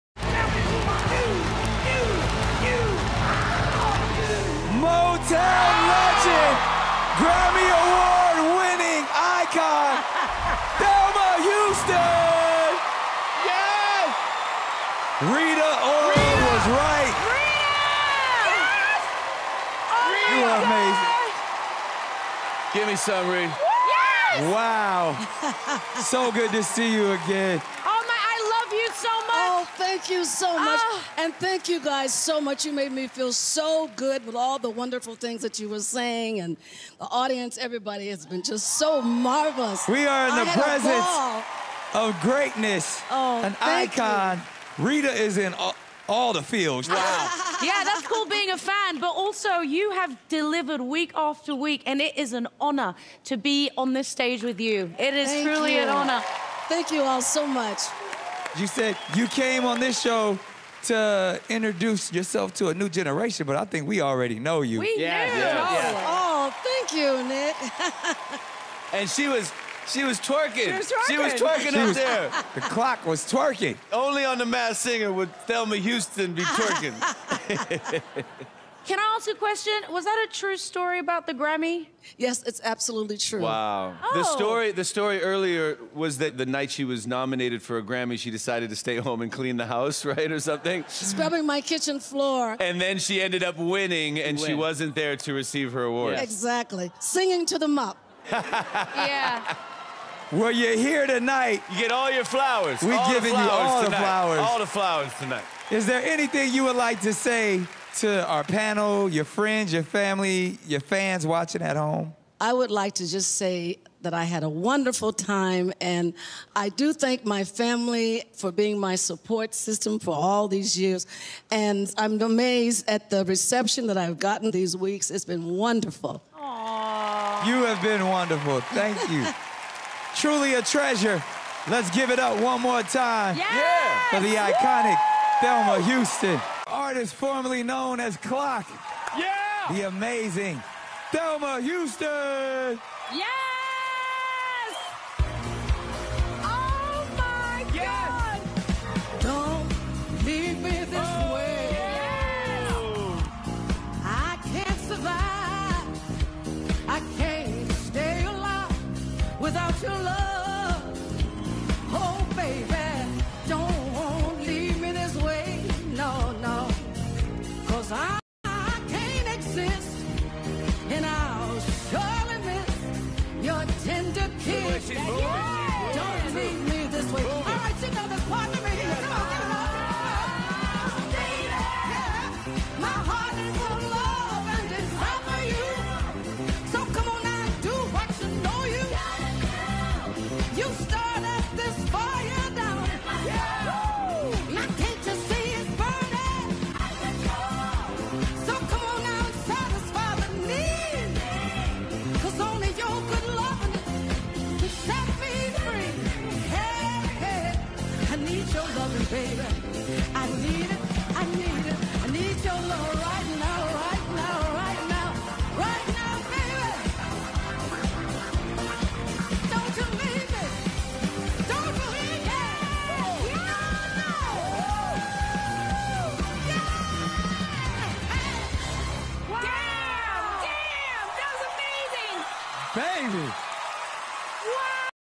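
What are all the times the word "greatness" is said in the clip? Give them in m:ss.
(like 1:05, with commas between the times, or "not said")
0:42.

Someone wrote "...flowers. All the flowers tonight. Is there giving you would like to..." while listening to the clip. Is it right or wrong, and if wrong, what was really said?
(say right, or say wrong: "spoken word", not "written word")
wrong: "anything", not "giving".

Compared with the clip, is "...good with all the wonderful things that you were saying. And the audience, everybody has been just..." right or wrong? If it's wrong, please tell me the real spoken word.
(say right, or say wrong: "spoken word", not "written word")
right.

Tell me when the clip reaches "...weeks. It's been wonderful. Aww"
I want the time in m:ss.
2:04.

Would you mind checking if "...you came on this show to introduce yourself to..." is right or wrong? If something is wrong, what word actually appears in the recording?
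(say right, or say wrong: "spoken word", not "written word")
right.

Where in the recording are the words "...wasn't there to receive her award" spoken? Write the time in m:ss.
1:34.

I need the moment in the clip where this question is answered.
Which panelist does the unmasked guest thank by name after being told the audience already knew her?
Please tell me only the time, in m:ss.
1:07.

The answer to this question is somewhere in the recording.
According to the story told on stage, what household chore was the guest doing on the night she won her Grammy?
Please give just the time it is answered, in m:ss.
1:30.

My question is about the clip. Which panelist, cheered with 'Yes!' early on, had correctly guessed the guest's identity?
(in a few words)
Rita Ora.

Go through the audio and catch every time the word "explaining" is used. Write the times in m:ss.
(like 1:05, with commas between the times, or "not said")
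not said.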